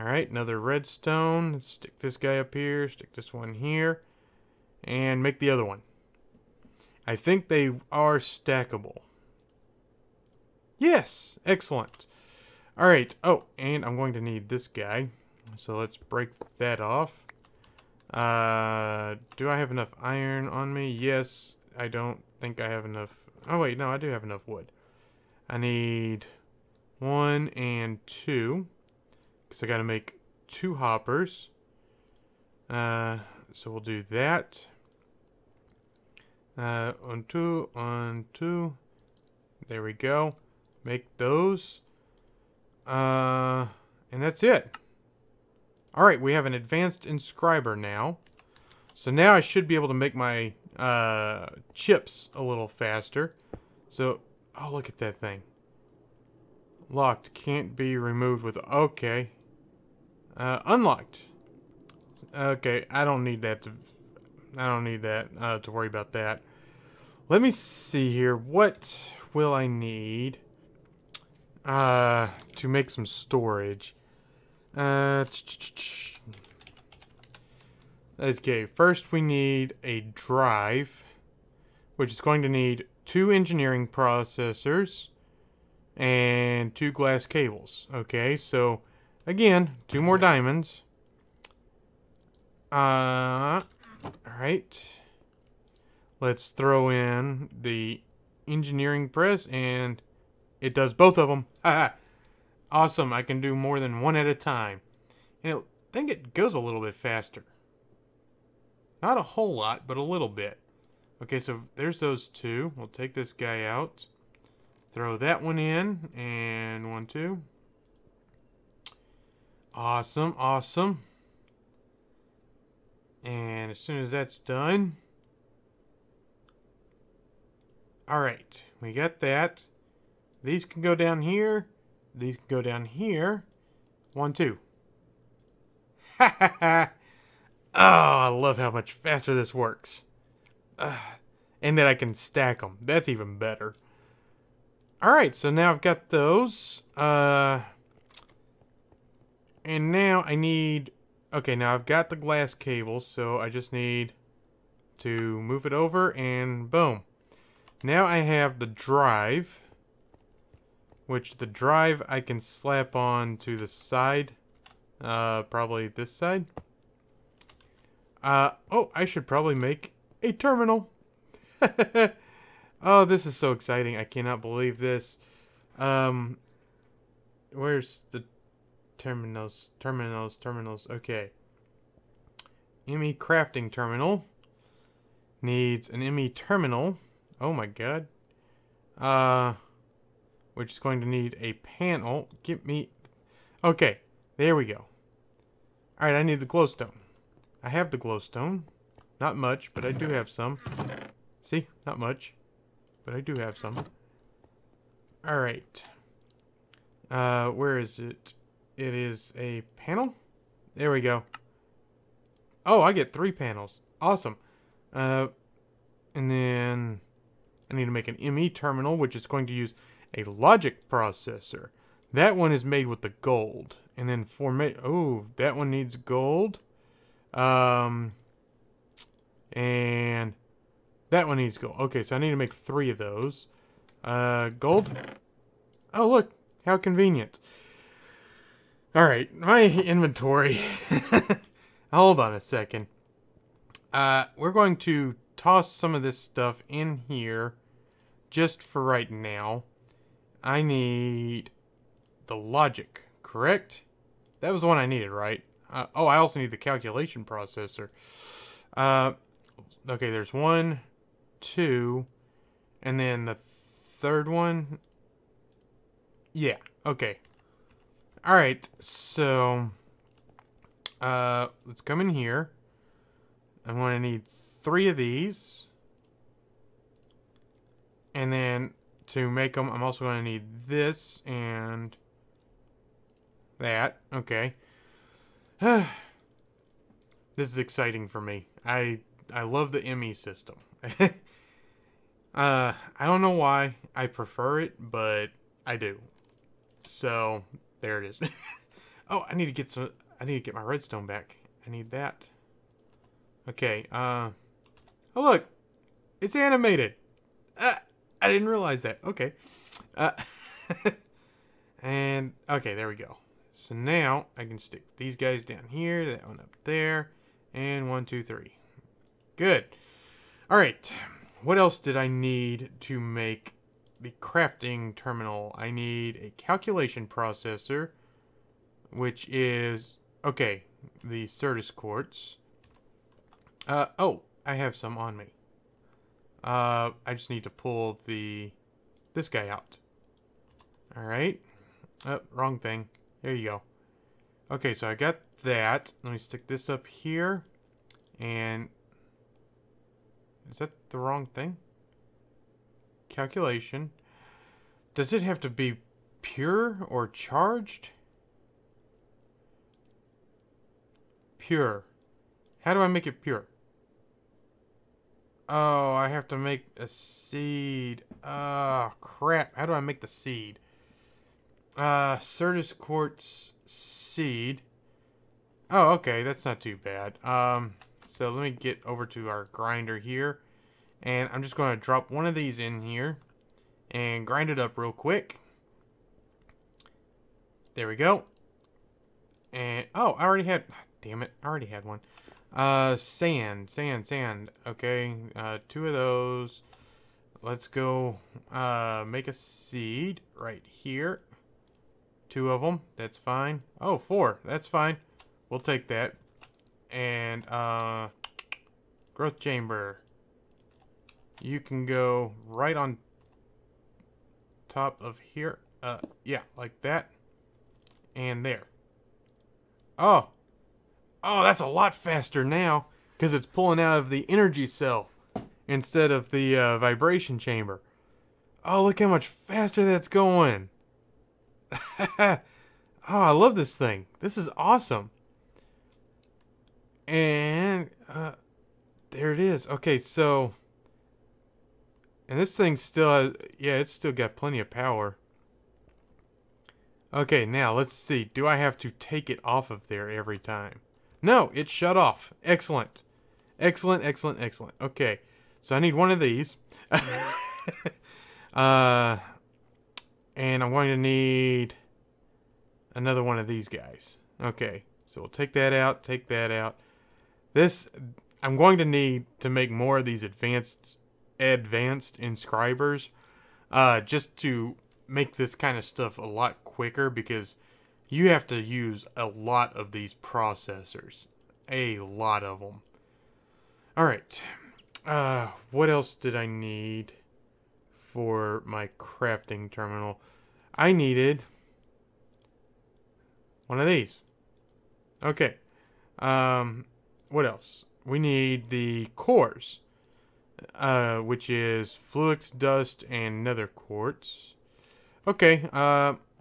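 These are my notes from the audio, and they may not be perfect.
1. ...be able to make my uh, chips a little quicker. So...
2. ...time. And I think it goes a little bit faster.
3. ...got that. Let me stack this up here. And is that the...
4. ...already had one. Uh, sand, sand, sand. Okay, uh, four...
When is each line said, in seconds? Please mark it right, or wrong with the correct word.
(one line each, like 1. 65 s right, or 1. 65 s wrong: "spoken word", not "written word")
1. 49 s wrong: "faster", not "quicker"
2. 104 s right
3. 344 s wrong: "stick", not "stack"
4. 391 s wrong: "two", not "four".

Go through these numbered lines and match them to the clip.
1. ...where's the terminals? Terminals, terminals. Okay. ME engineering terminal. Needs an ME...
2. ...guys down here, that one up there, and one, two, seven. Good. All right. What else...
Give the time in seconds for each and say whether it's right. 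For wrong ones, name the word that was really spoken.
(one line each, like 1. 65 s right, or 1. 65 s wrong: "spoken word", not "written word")
1. 177 s wrong: "crafting", not "engineering"
2. 315 s wrong: "three", not "seven".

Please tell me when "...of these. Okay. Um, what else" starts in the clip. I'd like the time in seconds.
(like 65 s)
493 s.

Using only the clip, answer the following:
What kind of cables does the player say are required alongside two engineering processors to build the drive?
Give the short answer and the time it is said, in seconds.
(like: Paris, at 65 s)
glass cables, at 86 s.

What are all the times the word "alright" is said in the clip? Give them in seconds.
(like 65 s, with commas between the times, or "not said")
45 s, 94 s, 128 s, 145 s, 196 s, 205 s, 483 s.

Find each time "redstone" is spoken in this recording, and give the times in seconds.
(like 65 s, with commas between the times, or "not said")
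0 s, 300 s.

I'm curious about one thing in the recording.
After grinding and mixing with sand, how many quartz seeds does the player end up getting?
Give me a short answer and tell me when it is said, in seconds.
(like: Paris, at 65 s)
4, at 403 s.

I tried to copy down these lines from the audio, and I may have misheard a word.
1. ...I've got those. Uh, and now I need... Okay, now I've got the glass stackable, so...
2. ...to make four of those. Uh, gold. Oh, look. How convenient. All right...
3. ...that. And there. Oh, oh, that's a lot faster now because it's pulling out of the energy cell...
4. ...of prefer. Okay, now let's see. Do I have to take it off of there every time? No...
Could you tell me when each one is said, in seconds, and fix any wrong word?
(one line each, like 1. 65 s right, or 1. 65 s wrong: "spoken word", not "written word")
1. 145 s wrong: "cable", not "stackable"
2. 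232 s wrong: "three", not "four"
3. 416 s right
4. 444 s wrong: "power", not "prefer".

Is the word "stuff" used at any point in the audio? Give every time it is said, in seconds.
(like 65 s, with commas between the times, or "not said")
246 s, 475 s.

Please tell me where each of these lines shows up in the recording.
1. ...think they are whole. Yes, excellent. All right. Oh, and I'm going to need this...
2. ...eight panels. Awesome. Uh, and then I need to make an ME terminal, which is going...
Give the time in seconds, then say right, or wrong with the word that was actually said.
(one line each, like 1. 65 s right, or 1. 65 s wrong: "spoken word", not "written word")
1. 7 s wrong: "stackable", not "whole"
2. 213 s wrong: "three", not "eight".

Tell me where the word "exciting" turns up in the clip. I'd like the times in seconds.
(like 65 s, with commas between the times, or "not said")
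173 s, 287 s.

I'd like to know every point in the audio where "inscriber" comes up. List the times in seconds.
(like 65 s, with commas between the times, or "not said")
47 s, 472 s.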